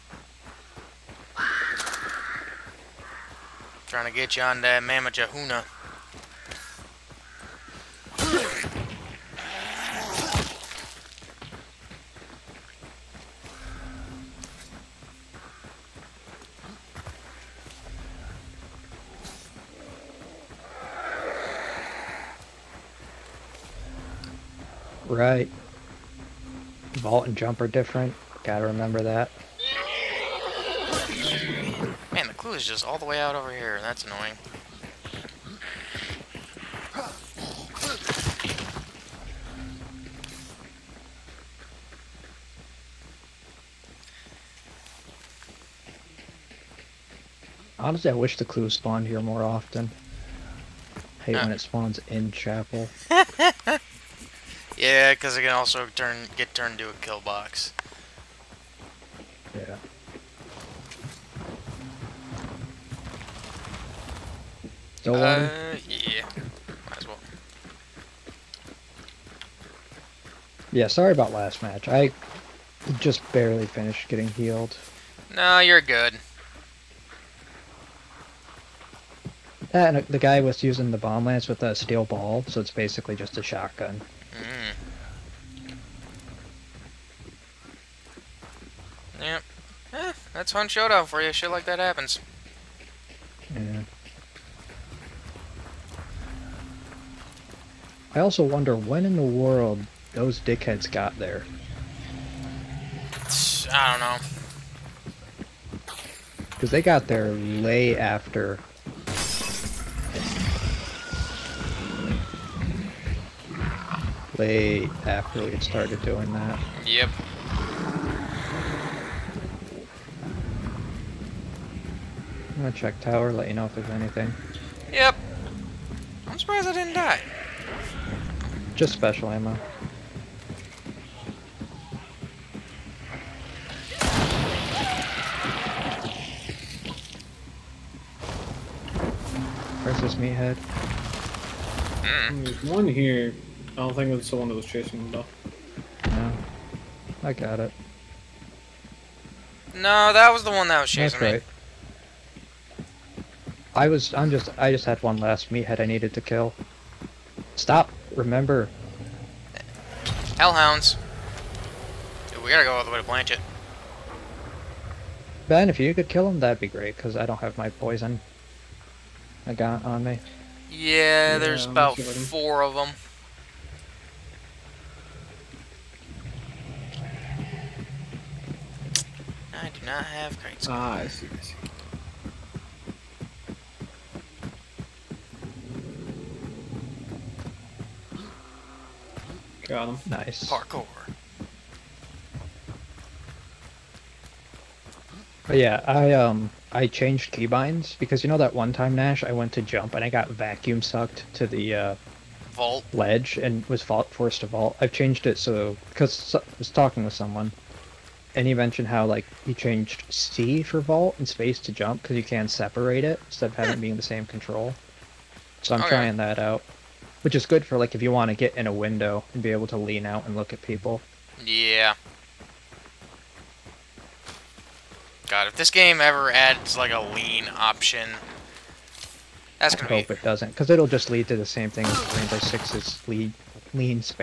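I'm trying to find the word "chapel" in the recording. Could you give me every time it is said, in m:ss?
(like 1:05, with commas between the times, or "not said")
0:52.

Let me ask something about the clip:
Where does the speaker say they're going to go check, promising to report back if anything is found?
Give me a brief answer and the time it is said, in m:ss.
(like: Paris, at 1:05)
tower, at 2:02.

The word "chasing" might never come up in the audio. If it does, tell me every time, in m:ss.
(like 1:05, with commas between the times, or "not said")
2:24, 2:30.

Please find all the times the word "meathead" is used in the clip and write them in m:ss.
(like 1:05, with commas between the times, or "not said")
2:20, 2:35.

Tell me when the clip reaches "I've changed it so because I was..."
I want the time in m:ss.
3:24.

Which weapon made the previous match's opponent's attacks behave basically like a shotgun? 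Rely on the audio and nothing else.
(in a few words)
bomb lance.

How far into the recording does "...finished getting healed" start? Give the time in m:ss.
1:13.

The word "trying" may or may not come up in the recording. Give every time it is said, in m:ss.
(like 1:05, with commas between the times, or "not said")
0:03, 3:35.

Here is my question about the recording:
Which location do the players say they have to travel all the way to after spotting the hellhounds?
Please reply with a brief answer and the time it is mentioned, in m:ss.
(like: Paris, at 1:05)
Blanchett, at 2:43.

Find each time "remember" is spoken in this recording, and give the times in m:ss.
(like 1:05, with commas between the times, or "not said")
0:28, 2:38.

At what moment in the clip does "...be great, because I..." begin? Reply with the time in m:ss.
2:46.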